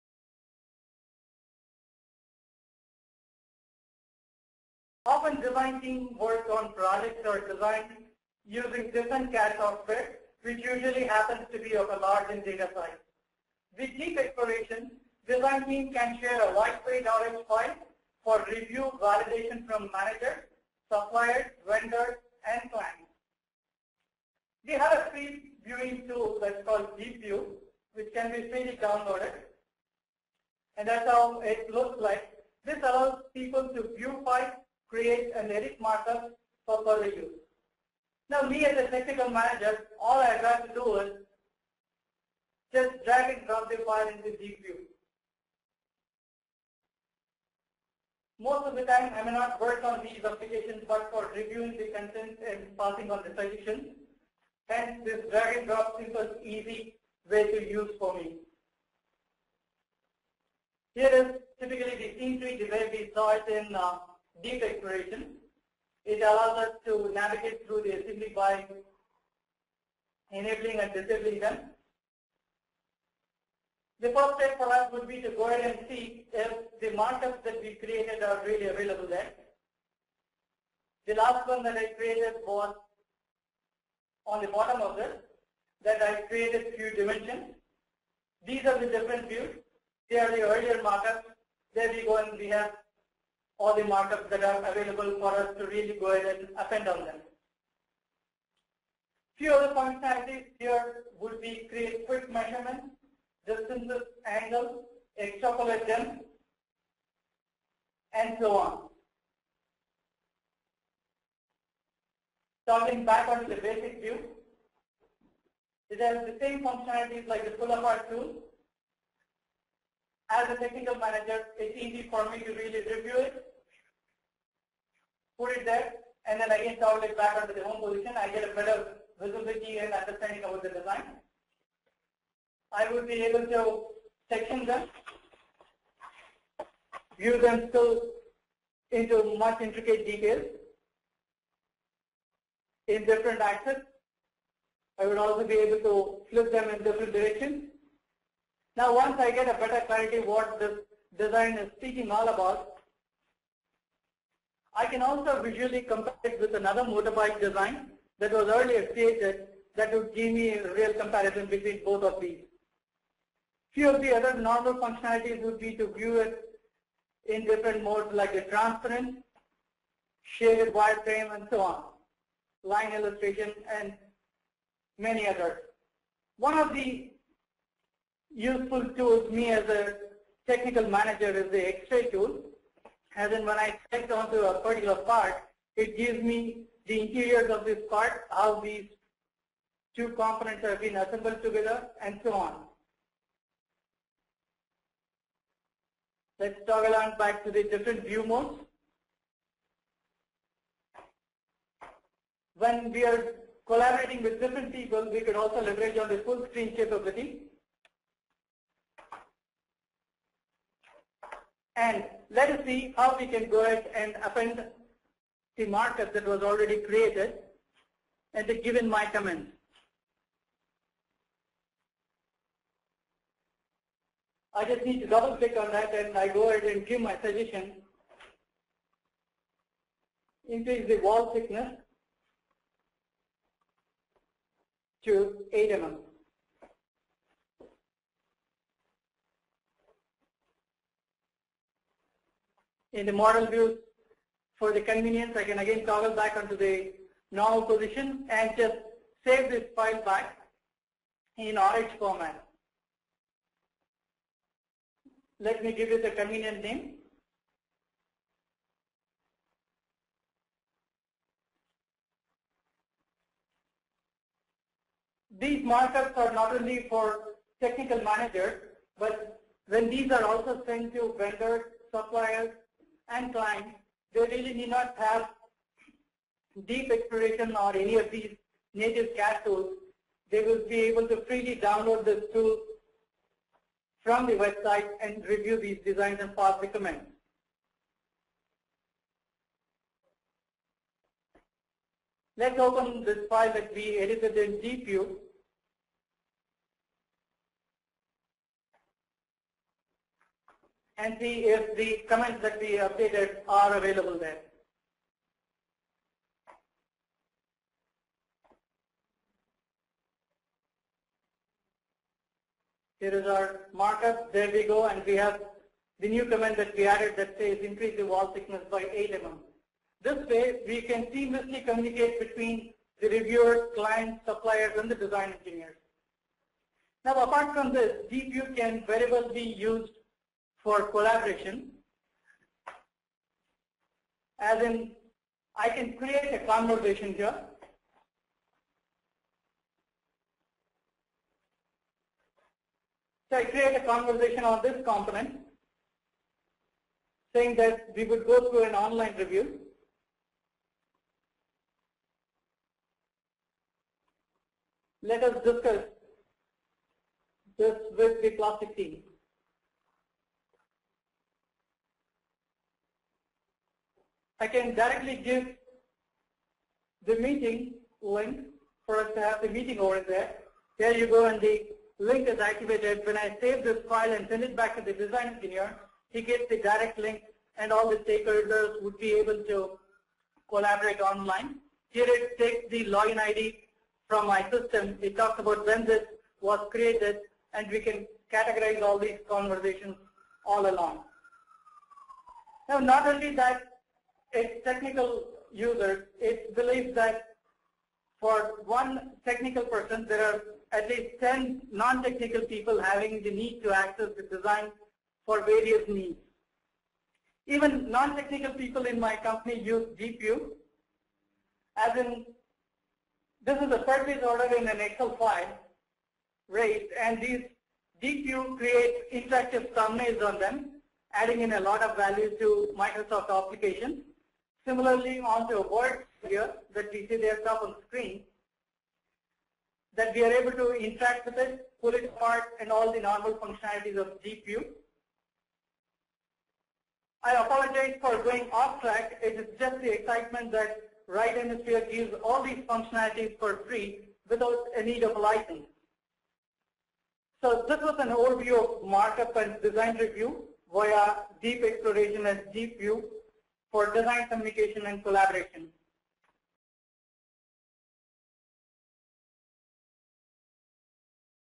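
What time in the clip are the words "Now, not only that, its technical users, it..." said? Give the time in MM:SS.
06:32.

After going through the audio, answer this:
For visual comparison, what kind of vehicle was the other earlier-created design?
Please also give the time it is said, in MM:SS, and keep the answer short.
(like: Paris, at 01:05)
motorbike, at 02:36.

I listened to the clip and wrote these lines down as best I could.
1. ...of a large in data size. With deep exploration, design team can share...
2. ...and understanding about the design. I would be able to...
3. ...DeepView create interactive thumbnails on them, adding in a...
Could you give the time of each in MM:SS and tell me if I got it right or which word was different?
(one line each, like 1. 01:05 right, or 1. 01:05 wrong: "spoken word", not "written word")
1. 00:11 right
2. 02:09 right
3. 06:58 right.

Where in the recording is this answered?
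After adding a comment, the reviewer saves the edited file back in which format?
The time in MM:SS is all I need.
04:11.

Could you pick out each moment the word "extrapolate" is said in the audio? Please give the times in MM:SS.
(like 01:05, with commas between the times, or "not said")
01:45.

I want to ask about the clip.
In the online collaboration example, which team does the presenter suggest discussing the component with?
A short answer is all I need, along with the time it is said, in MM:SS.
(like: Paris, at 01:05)
plastic team, at 05:58.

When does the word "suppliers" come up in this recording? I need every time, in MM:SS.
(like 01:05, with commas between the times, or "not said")
00:20, 04:31, 05:24.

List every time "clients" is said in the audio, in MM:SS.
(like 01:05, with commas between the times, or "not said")
00:22, 04:33, 05:23.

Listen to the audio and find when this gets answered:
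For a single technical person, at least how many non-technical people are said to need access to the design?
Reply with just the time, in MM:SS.
06:41.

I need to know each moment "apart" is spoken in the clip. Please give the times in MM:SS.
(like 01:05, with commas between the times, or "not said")
01:57, 05:27, 07:12.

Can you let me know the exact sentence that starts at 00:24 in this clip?
We have a free viewing tool that's called DeepView, which can be freely downloaded.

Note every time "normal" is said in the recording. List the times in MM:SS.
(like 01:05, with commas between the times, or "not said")
02:44, 04:07, 07:13.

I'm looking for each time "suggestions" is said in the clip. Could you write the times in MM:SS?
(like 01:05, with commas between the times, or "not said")
00:53, 03:47.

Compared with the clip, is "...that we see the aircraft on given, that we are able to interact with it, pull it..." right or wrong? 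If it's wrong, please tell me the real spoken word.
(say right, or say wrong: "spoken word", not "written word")
wrong: "screen", not "given".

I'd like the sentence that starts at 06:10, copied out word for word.
There you go, and the link is activated.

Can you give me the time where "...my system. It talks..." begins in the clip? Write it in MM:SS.
06:24.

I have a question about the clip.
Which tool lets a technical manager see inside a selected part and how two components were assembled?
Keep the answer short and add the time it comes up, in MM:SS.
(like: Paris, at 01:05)
X-ray tool, at 03:01.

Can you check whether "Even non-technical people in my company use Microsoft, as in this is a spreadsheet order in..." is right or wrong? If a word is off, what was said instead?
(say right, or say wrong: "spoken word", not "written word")
wrong: "DeepView", not "Microsoft".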